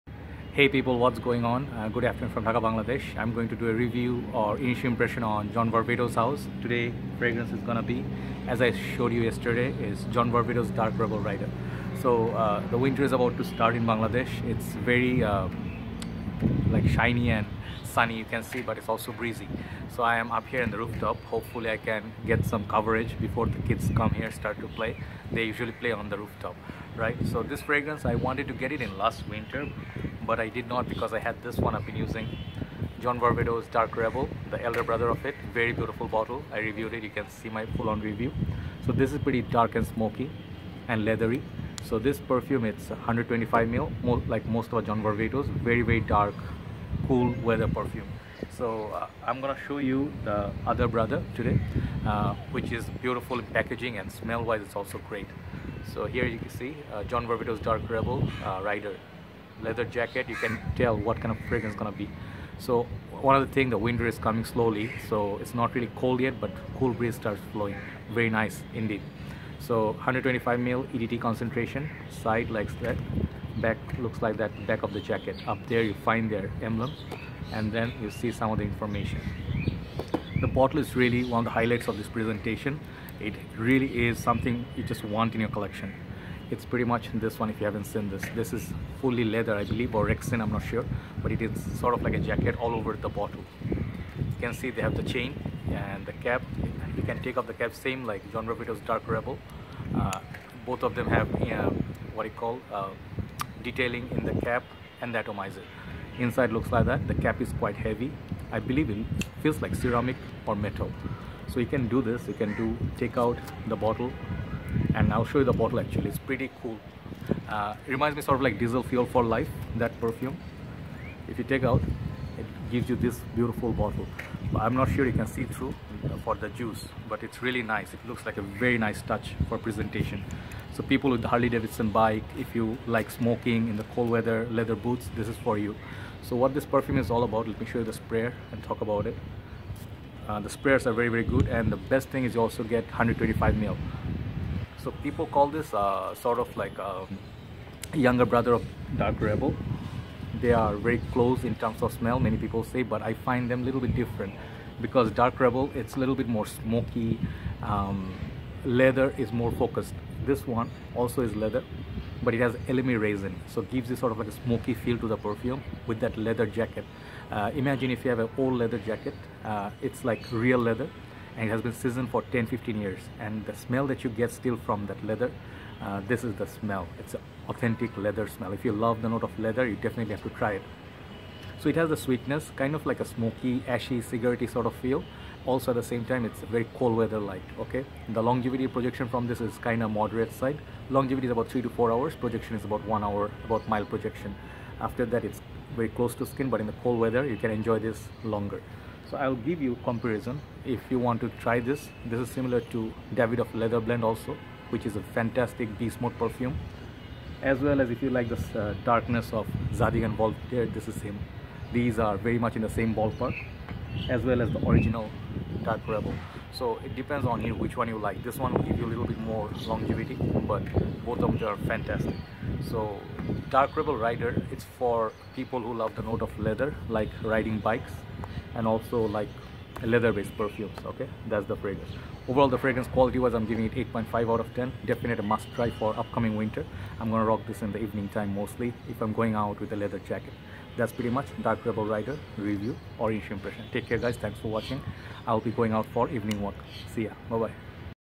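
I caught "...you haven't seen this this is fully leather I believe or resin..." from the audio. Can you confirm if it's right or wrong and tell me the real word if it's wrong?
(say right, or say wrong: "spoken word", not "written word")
wrong: "rexin", not "resin".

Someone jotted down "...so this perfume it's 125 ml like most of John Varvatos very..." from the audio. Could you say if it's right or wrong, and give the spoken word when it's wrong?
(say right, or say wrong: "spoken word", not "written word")
right.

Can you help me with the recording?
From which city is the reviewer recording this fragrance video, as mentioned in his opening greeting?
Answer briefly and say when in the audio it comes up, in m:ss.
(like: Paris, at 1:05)
Dhaka, at 0:02.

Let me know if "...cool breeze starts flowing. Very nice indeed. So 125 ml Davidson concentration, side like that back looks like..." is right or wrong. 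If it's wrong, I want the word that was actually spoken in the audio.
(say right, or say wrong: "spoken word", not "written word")
wrong: "EDT", not "Davidson".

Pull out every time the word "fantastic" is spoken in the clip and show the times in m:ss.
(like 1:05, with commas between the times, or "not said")
3:25, 3:41.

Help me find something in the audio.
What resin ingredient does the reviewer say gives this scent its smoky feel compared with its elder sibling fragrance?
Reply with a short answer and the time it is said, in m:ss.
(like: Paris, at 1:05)
elemi resin, at 2:42.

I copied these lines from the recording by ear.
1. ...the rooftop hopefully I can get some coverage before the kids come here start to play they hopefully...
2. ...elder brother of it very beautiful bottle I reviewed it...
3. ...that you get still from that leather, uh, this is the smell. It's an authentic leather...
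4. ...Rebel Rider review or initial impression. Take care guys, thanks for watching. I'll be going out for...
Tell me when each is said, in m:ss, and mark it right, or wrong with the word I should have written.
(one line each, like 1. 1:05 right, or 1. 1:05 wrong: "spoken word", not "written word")
1. 0:20 wrong: "usually", not "hopefully"
2. 0:34 right
3. 2:53 right
4. 4:01 right.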